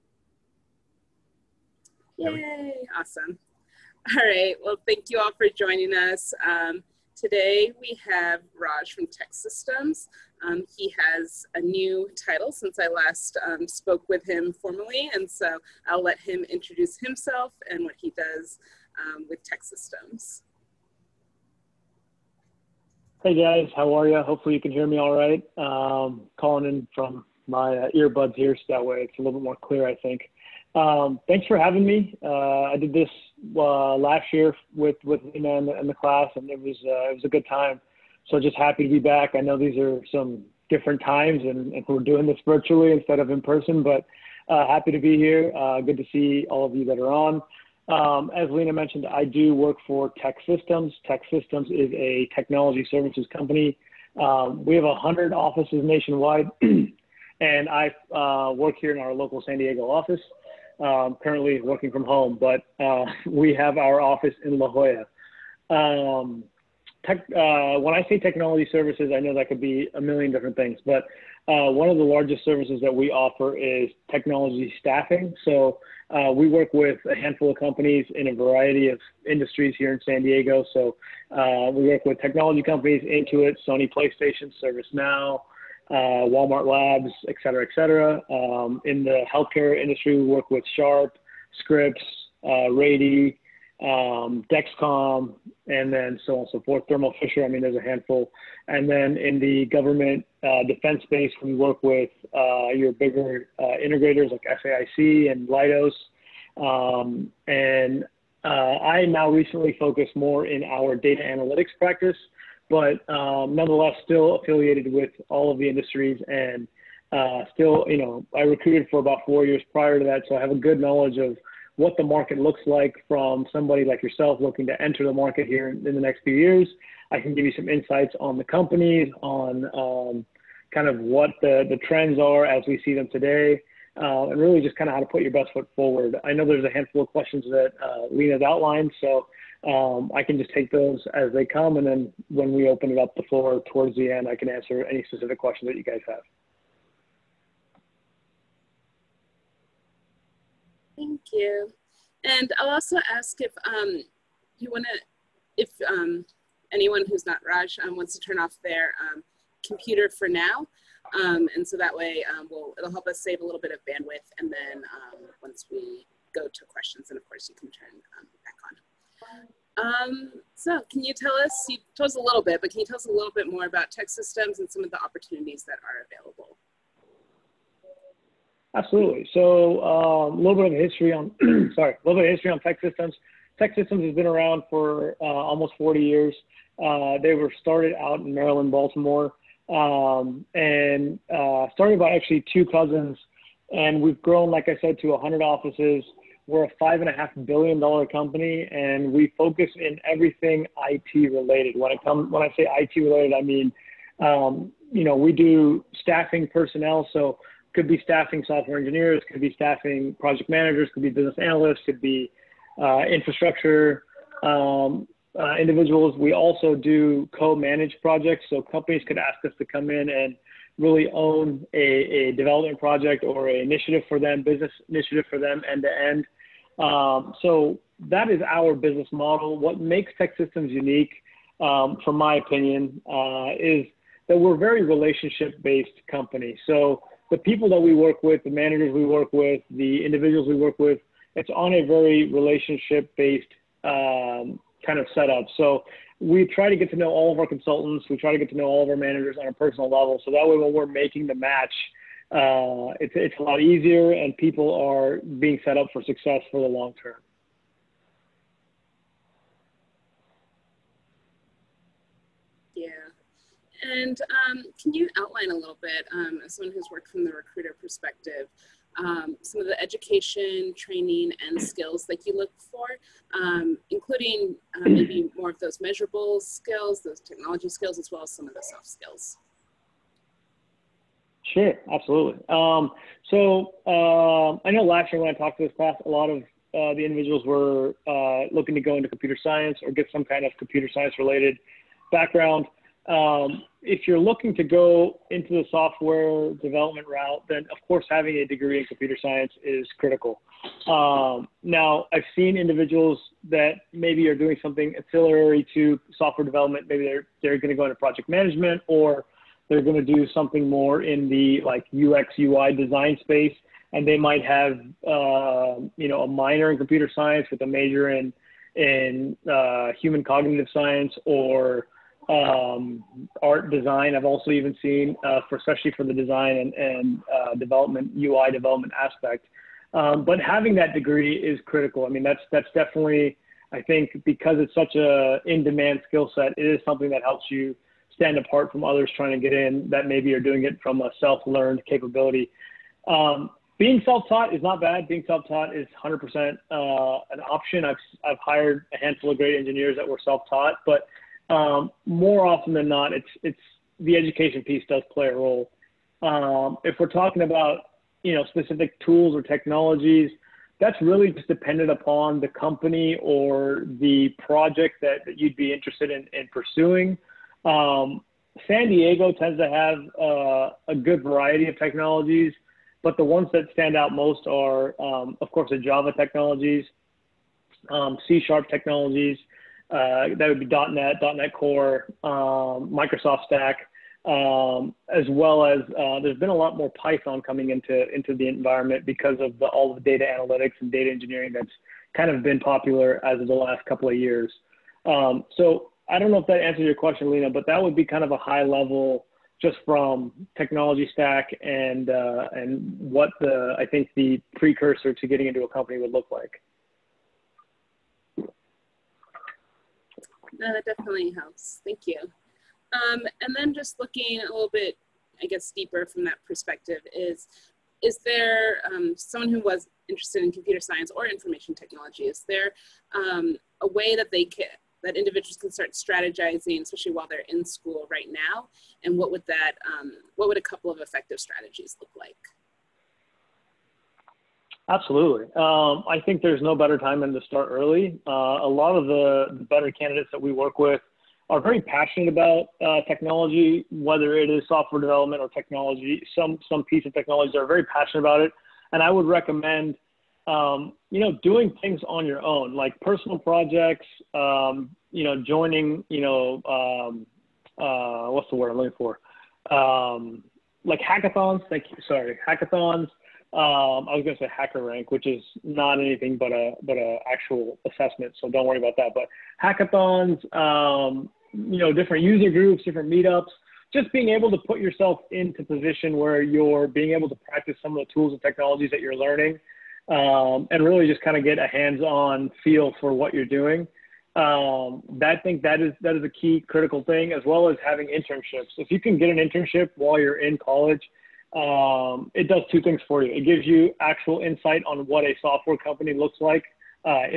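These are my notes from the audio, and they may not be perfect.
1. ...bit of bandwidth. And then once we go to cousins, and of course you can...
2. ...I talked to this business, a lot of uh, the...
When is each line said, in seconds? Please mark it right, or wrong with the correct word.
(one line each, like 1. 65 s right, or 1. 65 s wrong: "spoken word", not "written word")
1. 163 s wrong: "questions", not "cousins"
2. 285 s wrong: "class", not "business".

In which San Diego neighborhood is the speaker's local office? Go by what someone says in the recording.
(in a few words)
La Jolla.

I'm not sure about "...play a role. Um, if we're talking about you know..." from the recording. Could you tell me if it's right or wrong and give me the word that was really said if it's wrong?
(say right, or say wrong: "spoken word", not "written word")
right.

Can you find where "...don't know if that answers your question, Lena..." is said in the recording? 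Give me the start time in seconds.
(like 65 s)
396 s.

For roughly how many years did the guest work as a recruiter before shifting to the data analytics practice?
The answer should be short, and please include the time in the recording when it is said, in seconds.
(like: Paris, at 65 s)
4, at 118 s.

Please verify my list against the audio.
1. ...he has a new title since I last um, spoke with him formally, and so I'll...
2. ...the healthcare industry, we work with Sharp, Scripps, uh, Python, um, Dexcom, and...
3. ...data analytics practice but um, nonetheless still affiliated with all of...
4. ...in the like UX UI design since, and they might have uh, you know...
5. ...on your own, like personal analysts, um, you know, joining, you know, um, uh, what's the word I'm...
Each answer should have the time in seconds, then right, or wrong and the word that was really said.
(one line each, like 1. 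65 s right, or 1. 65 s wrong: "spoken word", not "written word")
1. 10 s right
2. 89 s wrong: "Rady", not "Python"
3. 110 s right
4. 311 s wrong: "space", not "since"
5. 452 s wrong: "projects", not "analysts".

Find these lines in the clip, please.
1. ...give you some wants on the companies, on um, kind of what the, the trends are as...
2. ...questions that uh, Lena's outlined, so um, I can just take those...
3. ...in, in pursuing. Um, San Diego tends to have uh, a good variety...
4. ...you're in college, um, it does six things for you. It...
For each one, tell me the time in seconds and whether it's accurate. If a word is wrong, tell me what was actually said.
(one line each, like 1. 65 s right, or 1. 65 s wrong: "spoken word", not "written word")
1. 127 s wrong: "insights", not "wants"
2. 137 s right
3. 366 s right
4. 490 s wrong: "two", not "six".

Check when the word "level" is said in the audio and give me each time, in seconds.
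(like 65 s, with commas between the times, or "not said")
249 s, 398 s.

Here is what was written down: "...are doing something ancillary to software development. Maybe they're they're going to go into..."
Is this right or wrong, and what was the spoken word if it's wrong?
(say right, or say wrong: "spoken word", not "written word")
right.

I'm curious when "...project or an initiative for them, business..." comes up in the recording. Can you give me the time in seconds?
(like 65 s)
222 s.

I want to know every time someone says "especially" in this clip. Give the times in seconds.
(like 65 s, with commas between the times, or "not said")
325 s, 426 s.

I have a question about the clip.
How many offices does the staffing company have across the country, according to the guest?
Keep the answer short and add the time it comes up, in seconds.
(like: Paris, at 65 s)
100, at 54 s.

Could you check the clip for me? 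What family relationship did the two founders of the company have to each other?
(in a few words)
Cousins.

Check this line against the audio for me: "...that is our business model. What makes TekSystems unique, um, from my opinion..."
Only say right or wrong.
right.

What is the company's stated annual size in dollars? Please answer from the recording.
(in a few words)
$5.5 billion.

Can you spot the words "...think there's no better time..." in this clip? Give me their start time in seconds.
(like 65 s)
436 s.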